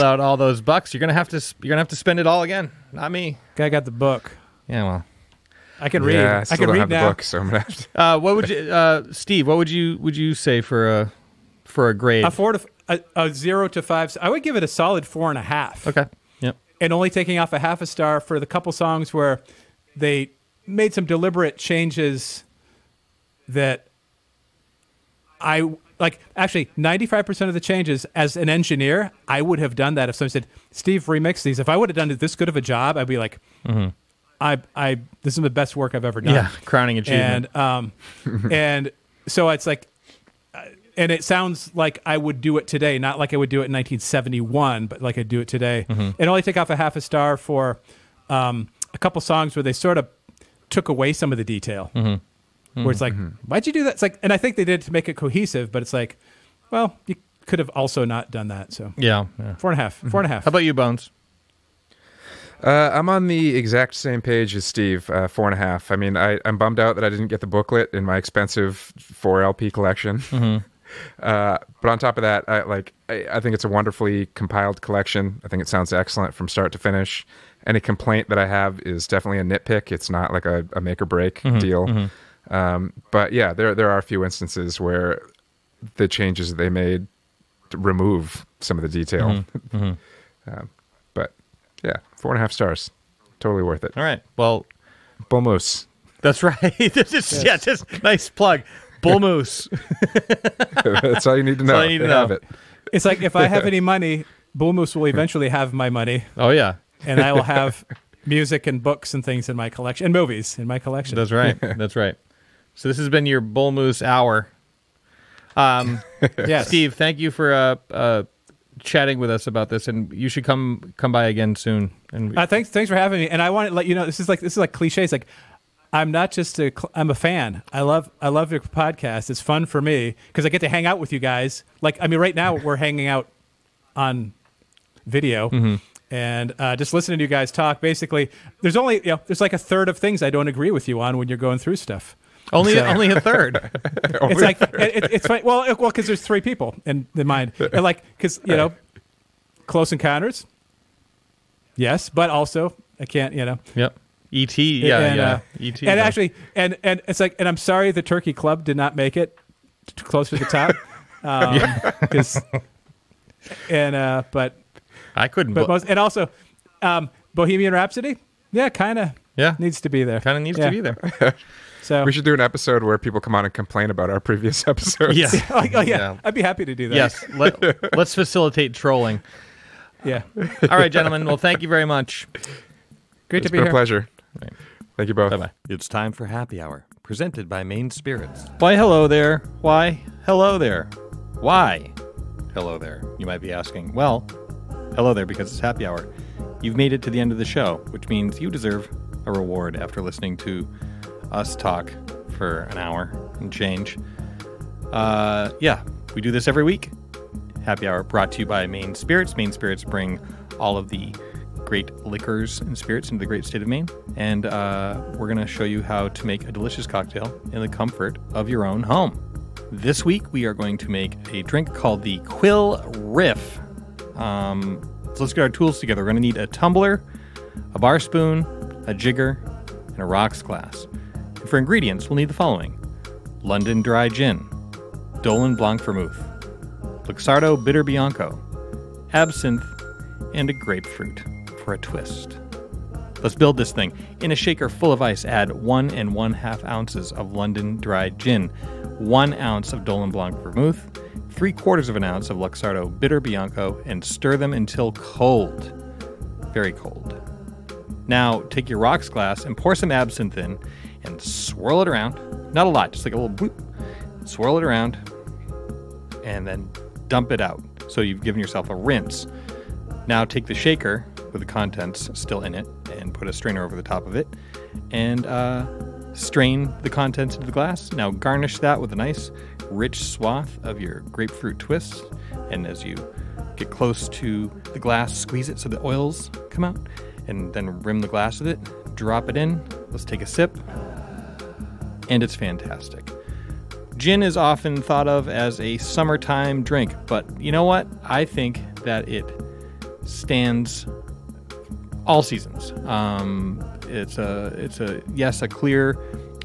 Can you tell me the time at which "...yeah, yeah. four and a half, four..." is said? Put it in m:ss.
0:58.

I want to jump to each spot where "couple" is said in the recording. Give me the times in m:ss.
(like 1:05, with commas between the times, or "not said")
0:18, 0:48.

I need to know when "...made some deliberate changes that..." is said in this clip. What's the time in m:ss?
0:20.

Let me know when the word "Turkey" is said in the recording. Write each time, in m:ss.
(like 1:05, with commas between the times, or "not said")
2:38.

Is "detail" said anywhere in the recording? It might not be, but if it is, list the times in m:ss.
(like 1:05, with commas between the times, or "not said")
0:51, 1:28.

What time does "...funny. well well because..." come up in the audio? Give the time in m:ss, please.
2:25.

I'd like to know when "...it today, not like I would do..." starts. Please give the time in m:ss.
0:42.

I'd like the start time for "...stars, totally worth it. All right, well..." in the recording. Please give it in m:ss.
1:32.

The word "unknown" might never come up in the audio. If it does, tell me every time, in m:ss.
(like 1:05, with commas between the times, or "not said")
not said.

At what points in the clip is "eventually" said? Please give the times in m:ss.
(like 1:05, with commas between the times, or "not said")
1:45.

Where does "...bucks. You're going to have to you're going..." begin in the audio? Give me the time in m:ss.
0:00.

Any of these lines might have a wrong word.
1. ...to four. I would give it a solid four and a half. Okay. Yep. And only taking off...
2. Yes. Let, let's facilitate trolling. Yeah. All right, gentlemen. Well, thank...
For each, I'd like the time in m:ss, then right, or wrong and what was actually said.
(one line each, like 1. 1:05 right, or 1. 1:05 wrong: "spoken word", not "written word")
1. 0:13 wrong: "five", not "four"
2. 2:56 right.